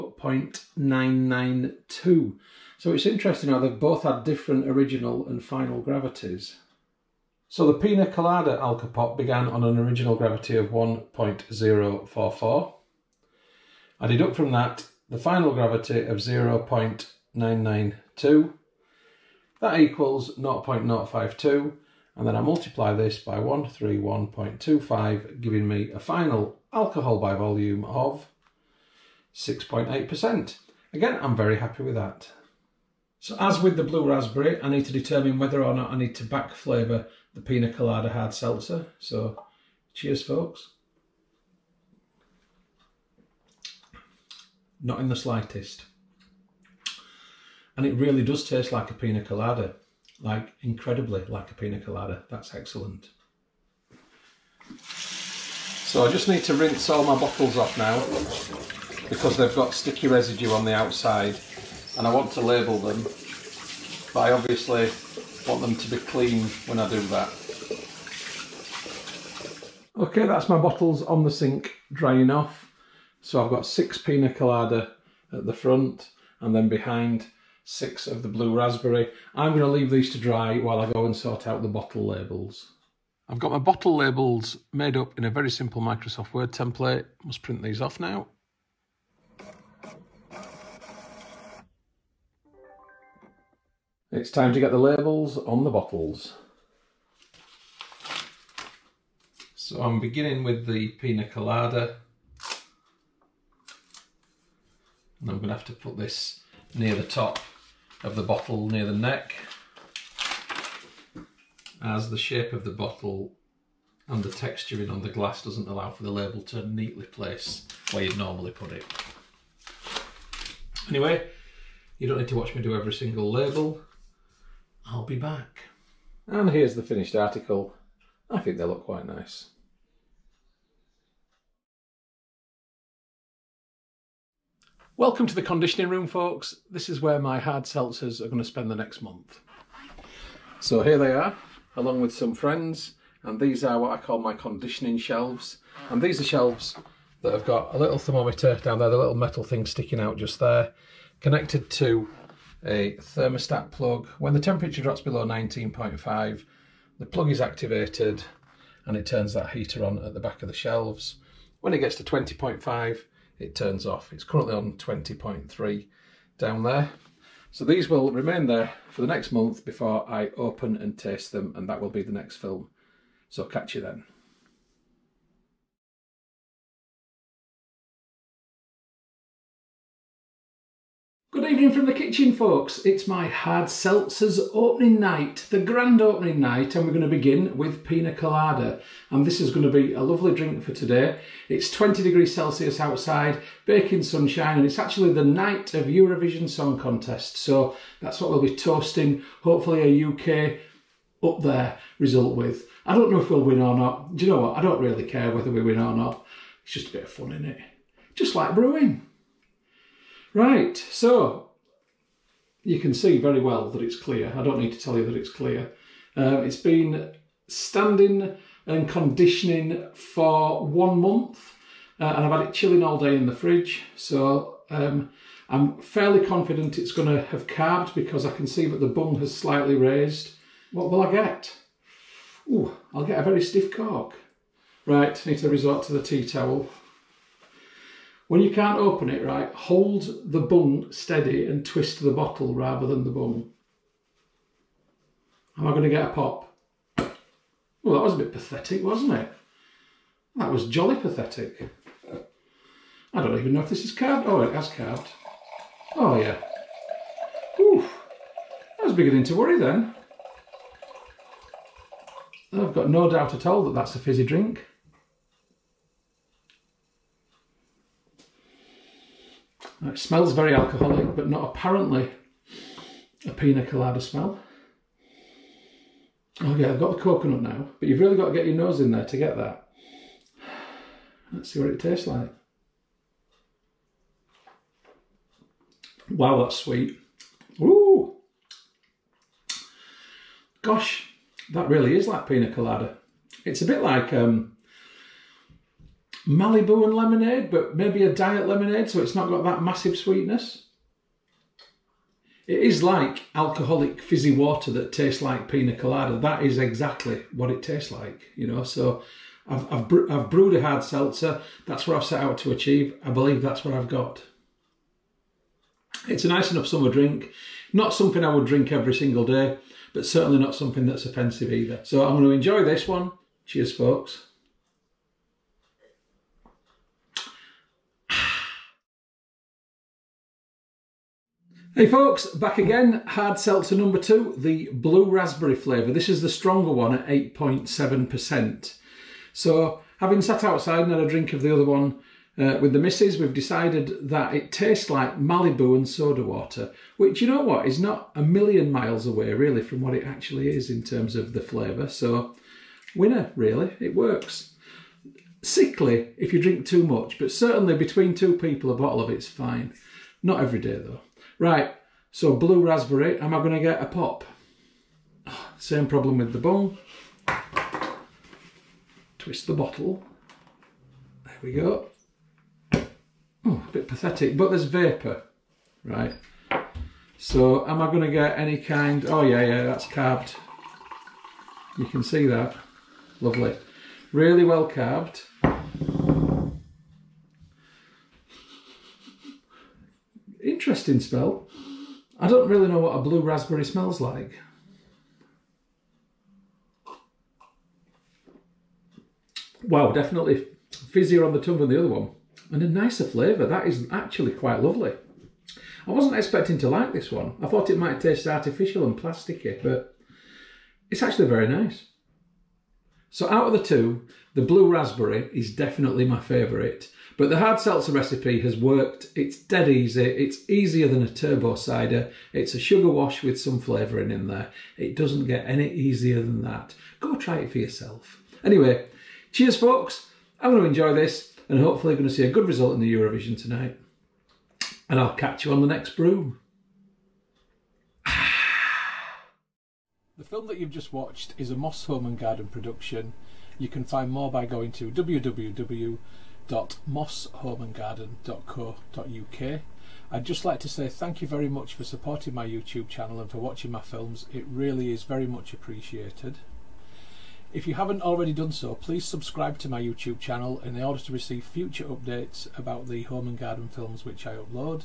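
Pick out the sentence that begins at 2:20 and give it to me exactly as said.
So here they are, along with some friends, and these are what I call my conditioning shelves.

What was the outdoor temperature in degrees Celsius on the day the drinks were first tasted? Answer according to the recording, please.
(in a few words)
20.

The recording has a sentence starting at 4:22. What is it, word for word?
I've got no doubt at all that that's a fizzy drink.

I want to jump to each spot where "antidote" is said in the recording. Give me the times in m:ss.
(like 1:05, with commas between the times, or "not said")
not said.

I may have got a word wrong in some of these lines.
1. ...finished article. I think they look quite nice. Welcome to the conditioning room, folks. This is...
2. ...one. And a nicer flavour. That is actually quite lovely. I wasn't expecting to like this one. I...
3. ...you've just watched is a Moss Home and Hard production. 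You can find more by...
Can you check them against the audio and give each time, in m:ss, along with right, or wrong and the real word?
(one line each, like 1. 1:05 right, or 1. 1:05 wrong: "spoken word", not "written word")
1. 2:06 right
2. 6:41 right
3. 7:20 wrong: "Garden", not "Hard".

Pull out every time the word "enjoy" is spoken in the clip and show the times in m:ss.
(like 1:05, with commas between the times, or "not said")
5:22, 7:10.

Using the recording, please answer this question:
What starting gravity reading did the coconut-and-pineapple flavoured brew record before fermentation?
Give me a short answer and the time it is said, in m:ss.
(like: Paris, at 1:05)
1.044, at 0:10.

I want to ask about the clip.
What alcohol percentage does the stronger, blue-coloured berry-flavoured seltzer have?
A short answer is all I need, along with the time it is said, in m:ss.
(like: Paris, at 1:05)
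8.7%, at 5:37.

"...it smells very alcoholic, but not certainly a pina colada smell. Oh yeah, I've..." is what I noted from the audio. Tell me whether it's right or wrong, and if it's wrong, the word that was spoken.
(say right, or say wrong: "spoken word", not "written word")
wrong: "apparently", not "certainly".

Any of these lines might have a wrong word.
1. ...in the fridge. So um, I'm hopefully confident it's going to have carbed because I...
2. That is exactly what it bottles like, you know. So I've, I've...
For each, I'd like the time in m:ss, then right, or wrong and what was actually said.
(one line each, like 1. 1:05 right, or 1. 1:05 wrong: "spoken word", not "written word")
1. 3:43 wrong: "fairly", not "hopefully"
2. 5:06 wrong: "tastes", not "bottles".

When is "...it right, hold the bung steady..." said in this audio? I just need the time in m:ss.
3:59.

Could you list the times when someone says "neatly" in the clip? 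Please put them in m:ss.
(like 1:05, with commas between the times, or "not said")
1:56.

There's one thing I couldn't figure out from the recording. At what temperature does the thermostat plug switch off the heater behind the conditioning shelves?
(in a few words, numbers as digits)
20.5.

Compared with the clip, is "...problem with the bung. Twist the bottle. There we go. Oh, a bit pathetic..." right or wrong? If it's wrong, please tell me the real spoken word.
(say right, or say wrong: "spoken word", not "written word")
right.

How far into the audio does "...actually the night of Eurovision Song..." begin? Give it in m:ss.
3:14.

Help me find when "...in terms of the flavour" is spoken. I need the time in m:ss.
5:50.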